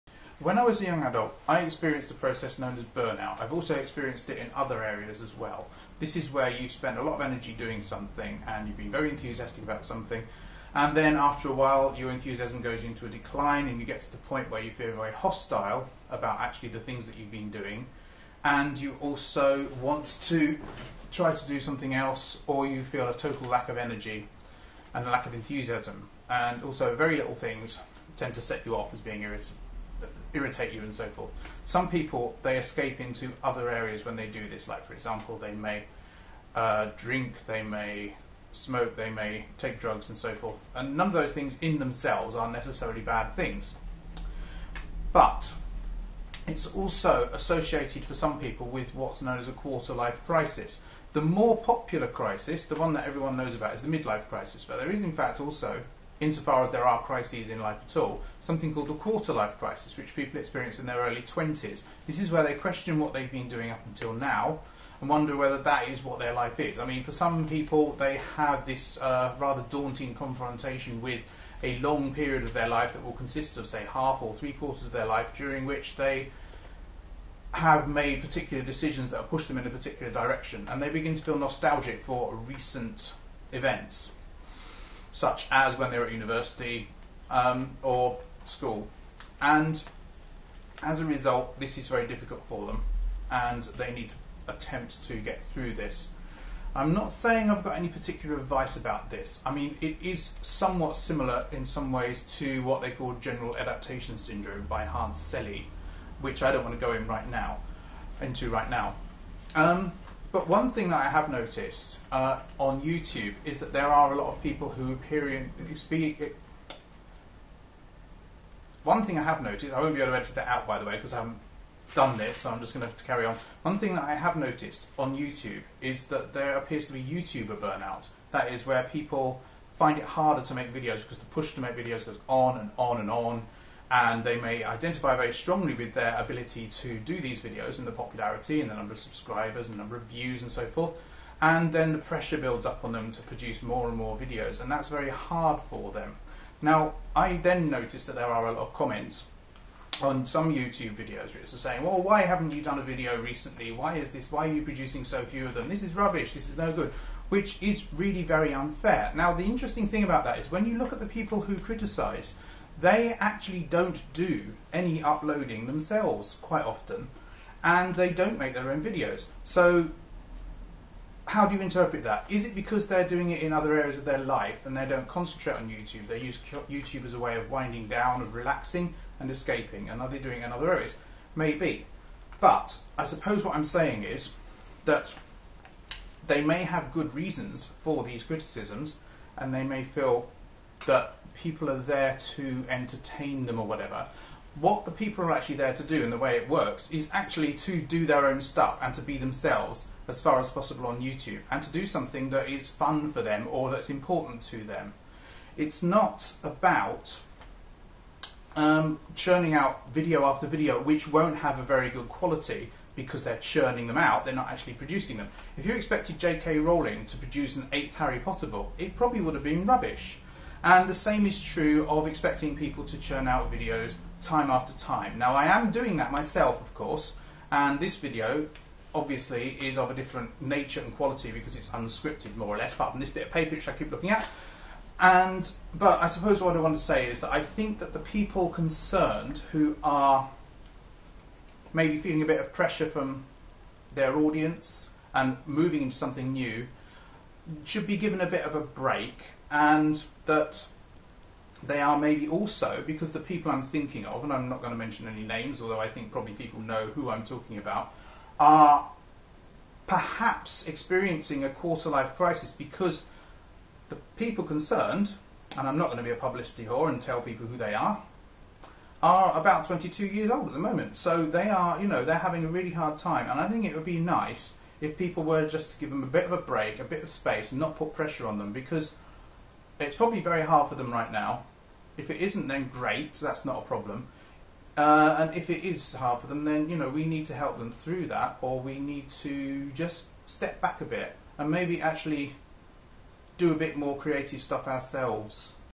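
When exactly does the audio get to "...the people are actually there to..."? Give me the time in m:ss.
3:14.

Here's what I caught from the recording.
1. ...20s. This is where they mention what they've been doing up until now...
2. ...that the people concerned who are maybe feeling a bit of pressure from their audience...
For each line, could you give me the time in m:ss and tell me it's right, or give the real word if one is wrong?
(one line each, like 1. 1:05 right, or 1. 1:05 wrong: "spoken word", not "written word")
1. 1:01 wrong: "question", not "mention"
2. 3:57 right.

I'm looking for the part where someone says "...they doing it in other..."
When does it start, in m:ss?
3:00.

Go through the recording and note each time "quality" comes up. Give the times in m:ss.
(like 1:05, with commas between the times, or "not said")
3:32, 3:50.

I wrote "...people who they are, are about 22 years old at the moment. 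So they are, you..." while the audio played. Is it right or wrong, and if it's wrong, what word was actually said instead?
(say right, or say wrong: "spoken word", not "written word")
right.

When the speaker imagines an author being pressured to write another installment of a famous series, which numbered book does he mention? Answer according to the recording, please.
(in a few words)
eighth.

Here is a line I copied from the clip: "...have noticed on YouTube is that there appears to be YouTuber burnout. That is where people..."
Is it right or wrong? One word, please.
right.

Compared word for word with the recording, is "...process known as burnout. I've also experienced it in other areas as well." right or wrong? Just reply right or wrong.
right.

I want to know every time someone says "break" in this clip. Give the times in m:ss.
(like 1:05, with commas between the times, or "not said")
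4:08, 4:36.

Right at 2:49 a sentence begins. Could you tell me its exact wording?
So, how do you interpret that?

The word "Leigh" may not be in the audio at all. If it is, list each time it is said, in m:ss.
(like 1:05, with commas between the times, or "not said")
not said.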